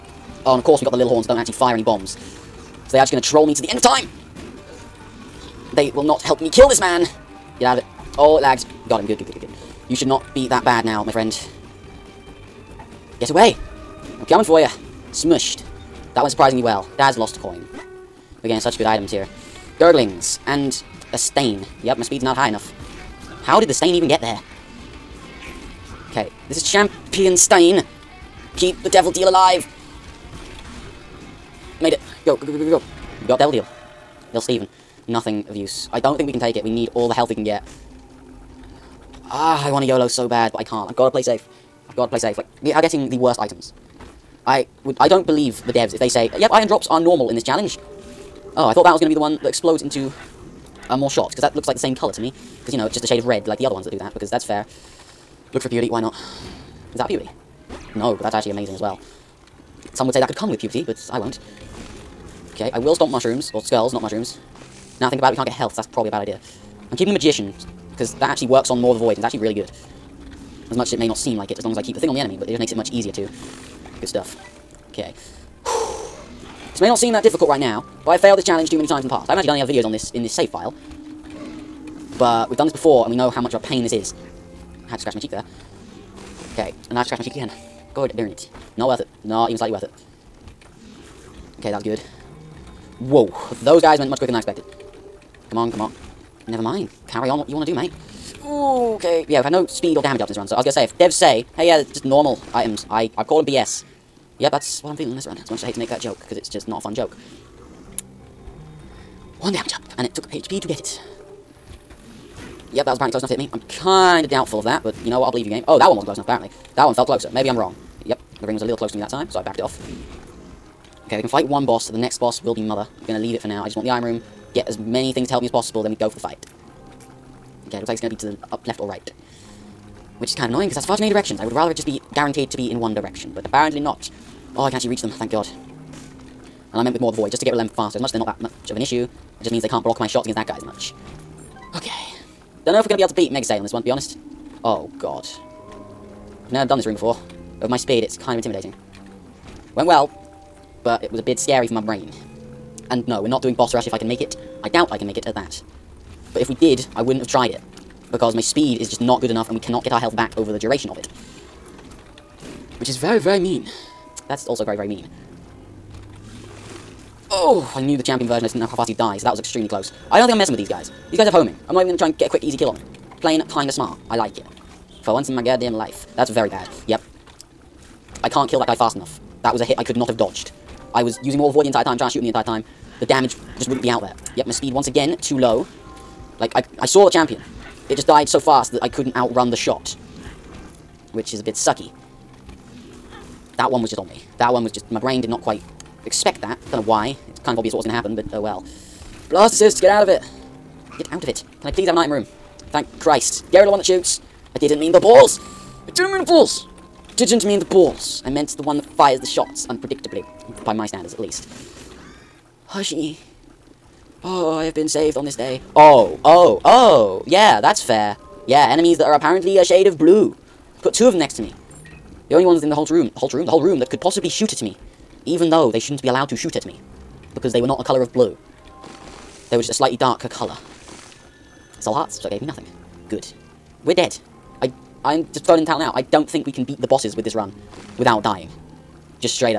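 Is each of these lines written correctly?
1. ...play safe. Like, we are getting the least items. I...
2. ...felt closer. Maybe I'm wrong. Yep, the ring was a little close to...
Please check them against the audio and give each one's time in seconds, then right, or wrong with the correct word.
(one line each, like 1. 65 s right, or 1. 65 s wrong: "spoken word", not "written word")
1. 42 s wrong: "worst", not "least"
2. 116 s right.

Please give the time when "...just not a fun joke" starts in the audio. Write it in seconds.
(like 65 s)
106 s.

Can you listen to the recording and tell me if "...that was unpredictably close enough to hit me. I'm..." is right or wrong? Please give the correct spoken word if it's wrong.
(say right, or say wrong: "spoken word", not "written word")
wrong: "apparently", not "unpredictably".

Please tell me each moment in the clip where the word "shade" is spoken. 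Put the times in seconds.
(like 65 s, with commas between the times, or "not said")
53 s, 219 s.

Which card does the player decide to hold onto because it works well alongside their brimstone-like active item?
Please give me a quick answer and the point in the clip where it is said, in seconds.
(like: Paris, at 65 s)
The Magician, at 67 s.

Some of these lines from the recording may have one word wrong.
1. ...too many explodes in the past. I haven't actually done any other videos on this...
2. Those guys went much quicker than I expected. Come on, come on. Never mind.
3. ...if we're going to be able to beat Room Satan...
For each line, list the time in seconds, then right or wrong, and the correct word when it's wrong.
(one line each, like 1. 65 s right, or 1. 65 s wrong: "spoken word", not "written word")
1. 78 s wrong: "times", not "explodes"
2. 93 s right
3. 142 s wrong: "Mega", not "Room".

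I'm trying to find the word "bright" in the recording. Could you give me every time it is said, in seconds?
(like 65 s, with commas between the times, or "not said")
not said.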